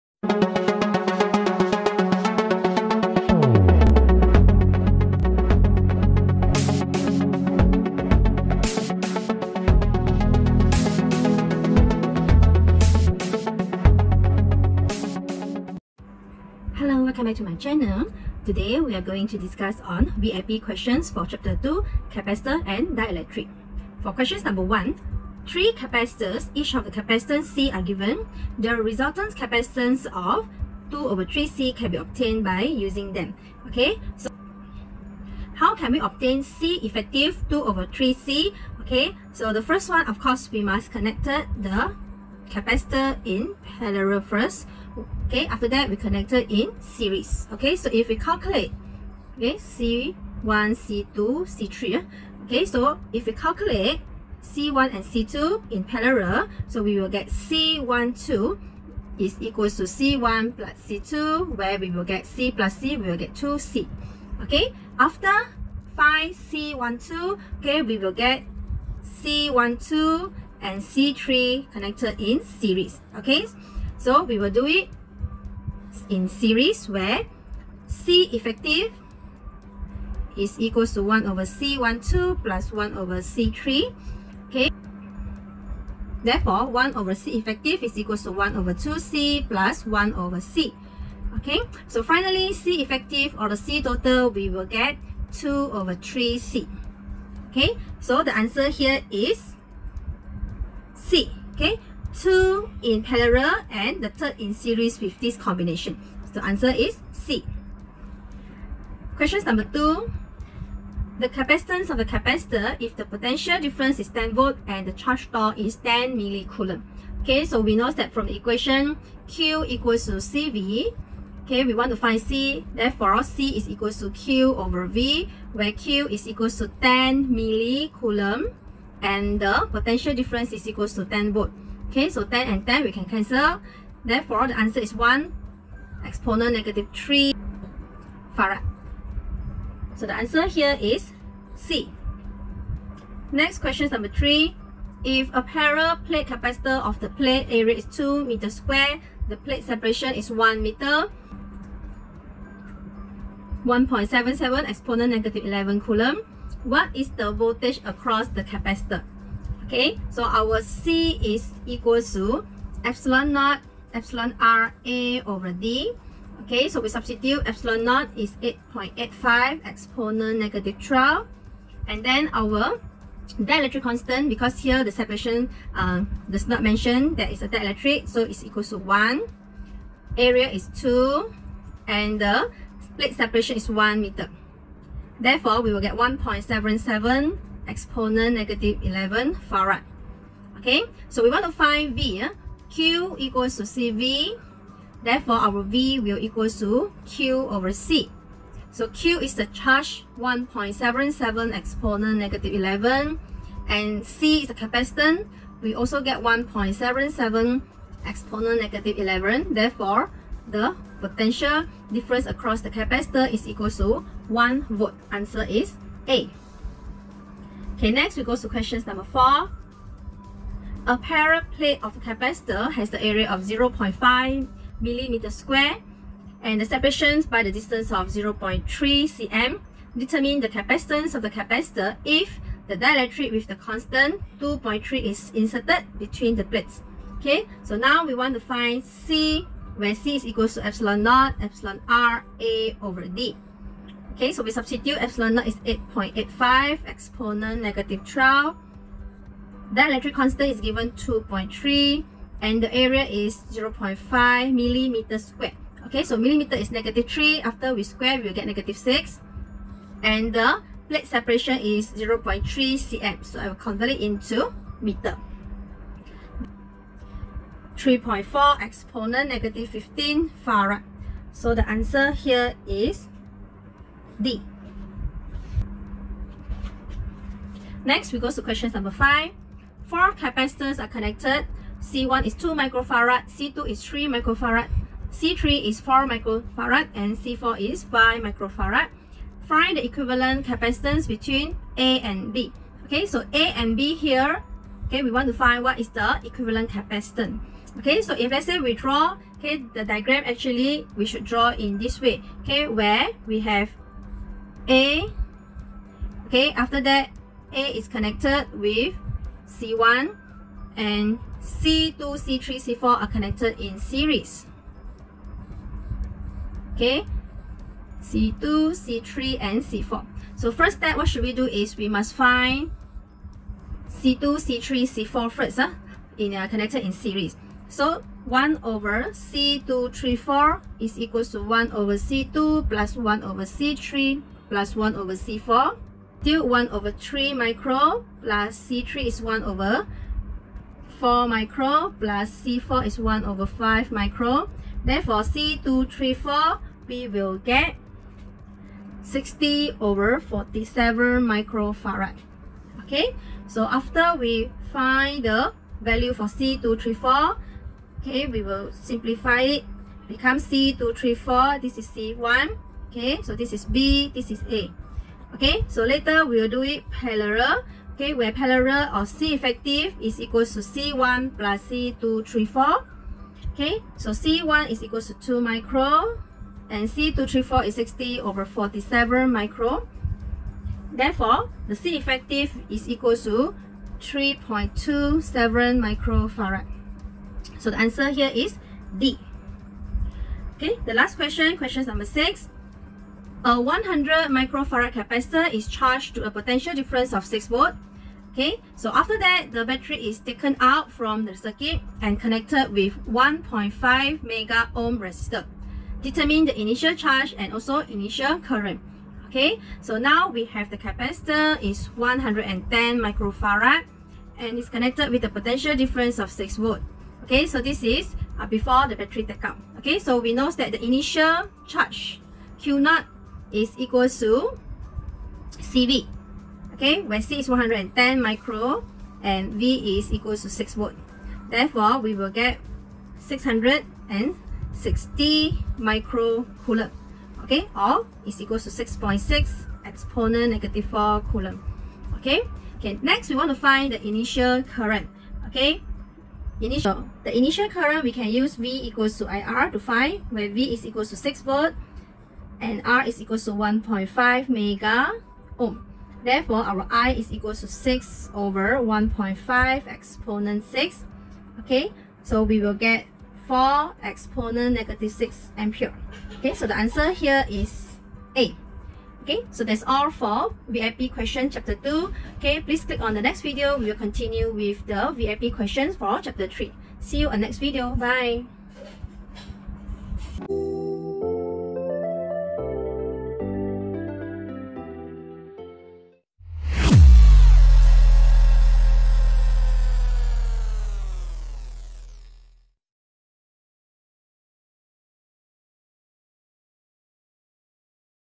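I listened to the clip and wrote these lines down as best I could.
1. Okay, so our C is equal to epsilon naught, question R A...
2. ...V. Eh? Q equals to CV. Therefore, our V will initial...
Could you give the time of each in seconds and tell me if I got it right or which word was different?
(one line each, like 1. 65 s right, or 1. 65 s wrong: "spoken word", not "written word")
1. 159 s wrong: "epsilon", not "question"
2. 191 s wrong: "equal", not "initial".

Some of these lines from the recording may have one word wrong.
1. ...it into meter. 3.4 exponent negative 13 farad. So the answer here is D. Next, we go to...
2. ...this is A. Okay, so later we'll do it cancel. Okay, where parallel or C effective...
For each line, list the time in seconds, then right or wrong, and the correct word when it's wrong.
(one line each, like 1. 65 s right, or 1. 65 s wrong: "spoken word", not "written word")
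1. 263 s wrong: "15", not "13"
2. 364 s wrong: "parallel", not "cancel".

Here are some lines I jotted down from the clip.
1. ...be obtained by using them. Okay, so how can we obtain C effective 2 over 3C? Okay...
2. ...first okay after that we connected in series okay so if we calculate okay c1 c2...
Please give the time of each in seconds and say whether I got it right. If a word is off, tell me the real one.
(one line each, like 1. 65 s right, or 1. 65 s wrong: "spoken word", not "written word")
1. 31 s right
2. 44 s right.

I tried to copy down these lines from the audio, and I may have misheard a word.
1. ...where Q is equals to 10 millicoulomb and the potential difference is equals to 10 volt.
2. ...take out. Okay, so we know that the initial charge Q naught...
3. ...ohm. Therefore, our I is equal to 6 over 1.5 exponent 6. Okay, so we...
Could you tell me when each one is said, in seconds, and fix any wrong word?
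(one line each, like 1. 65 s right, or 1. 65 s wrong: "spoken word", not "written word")
1. 125 s right
2. 419 s right
3. 455 s right.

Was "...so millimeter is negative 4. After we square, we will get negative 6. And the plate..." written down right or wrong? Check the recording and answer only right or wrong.
wrong.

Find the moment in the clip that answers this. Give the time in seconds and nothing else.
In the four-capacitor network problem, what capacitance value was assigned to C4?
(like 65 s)
287 s.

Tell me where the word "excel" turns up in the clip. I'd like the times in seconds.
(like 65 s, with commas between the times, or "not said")
not said.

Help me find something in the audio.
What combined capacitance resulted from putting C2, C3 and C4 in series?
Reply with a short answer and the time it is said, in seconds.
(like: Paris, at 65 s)
60/47 microfarad, at 349 s.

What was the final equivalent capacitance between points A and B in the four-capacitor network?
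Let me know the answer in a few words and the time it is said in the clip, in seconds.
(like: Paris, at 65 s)
3.27 microfarad, at 384 s.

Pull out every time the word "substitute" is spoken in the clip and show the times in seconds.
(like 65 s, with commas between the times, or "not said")
166 s, 244 s.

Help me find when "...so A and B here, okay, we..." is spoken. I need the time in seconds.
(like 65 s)
293 s.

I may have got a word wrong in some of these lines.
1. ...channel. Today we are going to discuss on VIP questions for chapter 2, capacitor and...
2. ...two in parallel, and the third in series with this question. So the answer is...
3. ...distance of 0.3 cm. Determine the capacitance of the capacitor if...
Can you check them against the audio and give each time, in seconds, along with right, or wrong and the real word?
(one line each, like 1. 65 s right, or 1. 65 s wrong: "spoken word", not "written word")
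1. 17 s right
2. 102 s wrong: "combination", not "question"
3. 227 s right.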